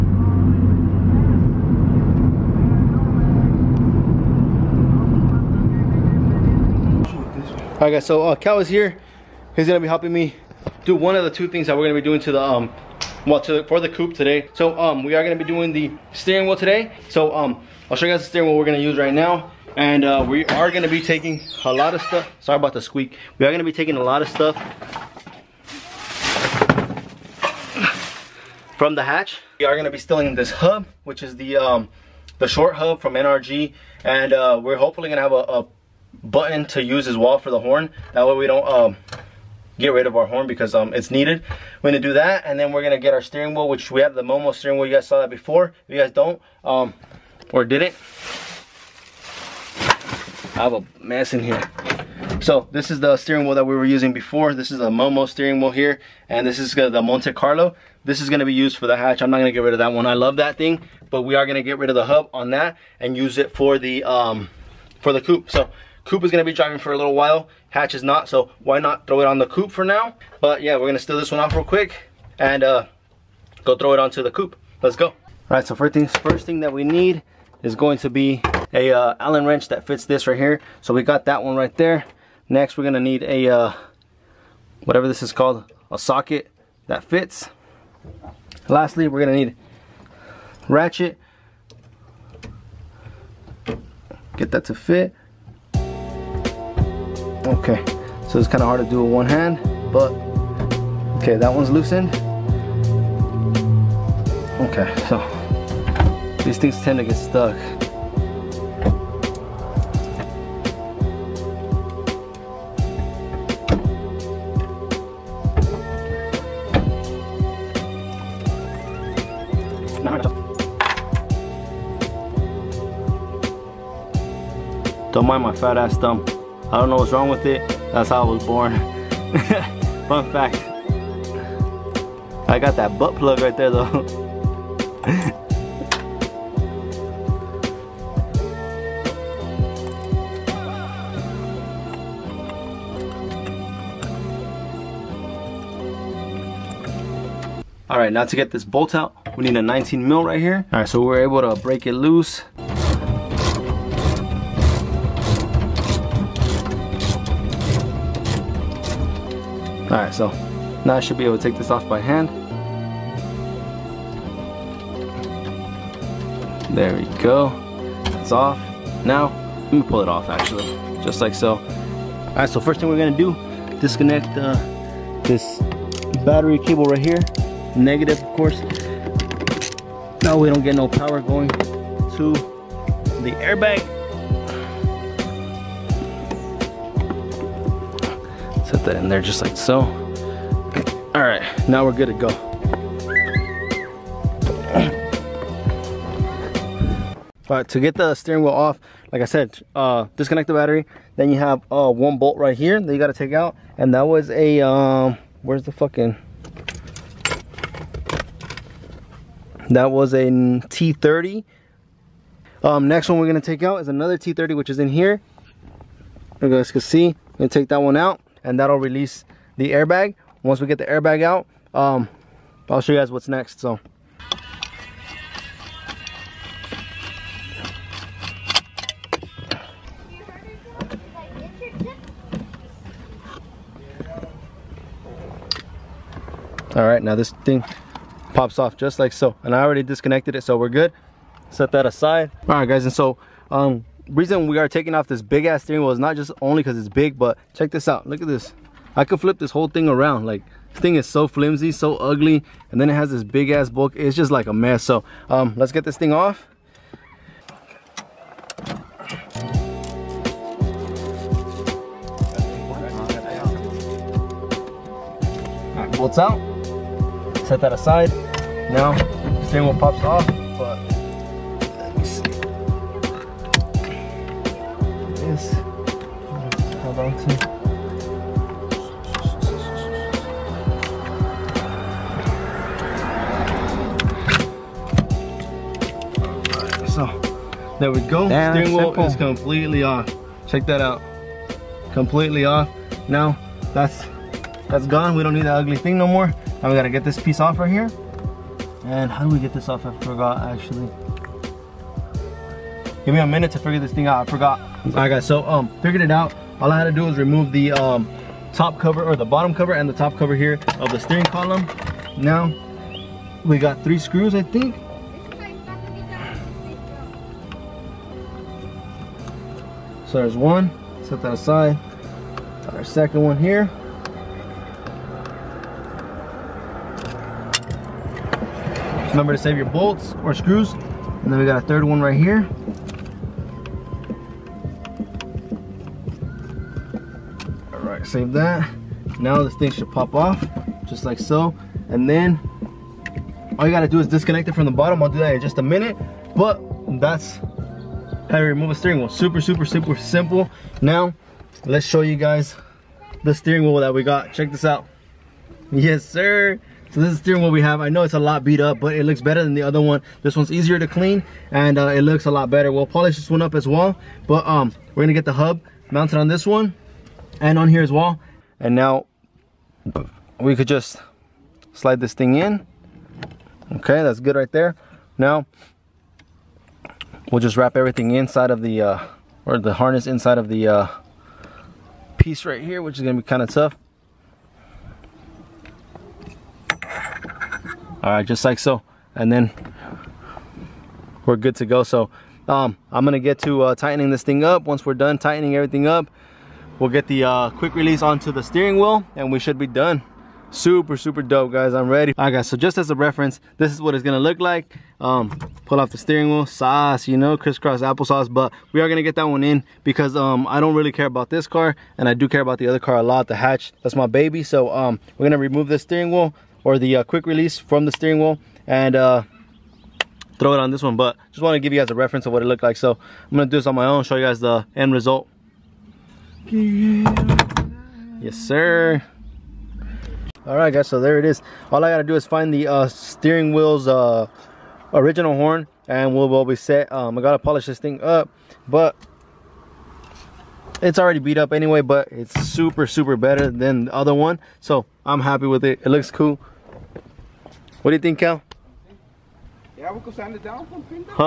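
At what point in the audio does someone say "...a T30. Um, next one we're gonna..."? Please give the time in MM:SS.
03:30.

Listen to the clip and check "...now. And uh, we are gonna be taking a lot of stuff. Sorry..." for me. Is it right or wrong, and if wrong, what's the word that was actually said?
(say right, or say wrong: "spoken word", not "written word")
right.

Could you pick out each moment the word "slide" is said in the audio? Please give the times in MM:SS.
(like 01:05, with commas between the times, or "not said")
06:11.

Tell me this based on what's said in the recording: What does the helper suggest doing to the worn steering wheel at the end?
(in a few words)
Sand it down.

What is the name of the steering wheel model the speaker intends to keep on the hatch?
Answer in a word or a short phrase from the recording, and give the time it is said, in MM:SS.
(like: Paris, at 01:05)
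Monte Carlo, at 00:57.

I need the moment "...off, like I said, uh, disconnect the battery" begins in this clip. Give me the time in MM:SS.
03:18.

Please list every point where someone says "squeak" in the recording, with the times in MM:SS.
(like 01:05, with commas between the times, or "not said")
00:22.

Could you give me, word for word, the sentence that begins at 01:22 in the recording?
Next, we're going to need a, uh, whatever this is called, a socket that fits.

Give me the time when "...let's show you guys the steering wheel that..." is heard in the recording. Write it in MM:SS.
05:51.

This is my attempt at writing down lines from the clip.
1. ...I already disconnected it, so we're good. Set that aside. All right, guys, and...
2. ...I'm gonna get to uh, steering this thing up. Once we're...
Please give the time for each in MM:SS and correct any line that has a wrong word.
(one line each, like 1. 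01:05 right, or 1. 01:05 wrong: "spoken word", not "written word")
1. 03:59 right
2. 06:32 wrong: "tightening", not "steering".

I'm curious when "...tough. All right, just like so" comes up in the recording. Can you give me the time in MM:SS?
06:23.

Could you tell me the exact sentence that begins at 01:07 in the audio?
Hatch is not, so why not throw it on the coupe for now?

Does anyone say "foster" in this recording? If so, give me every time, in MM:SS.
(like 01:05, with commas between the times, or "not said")
not said.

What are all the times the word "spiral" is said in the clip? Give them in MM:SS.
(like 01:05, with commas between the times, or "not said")
not said.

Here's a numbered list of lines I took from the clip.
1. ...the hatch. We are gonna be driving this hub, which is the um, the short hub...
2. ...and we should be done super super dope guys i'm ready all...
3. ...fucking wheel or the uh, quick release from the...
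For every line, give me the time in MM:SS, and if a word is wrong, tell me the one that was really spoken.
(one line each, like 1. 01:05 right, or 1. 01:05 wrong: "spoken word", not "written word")
1. 00:28 wrong: "stealing", not "driving"
2. 06:39 right
3. 06:55 wrong: "steering", not "fucking".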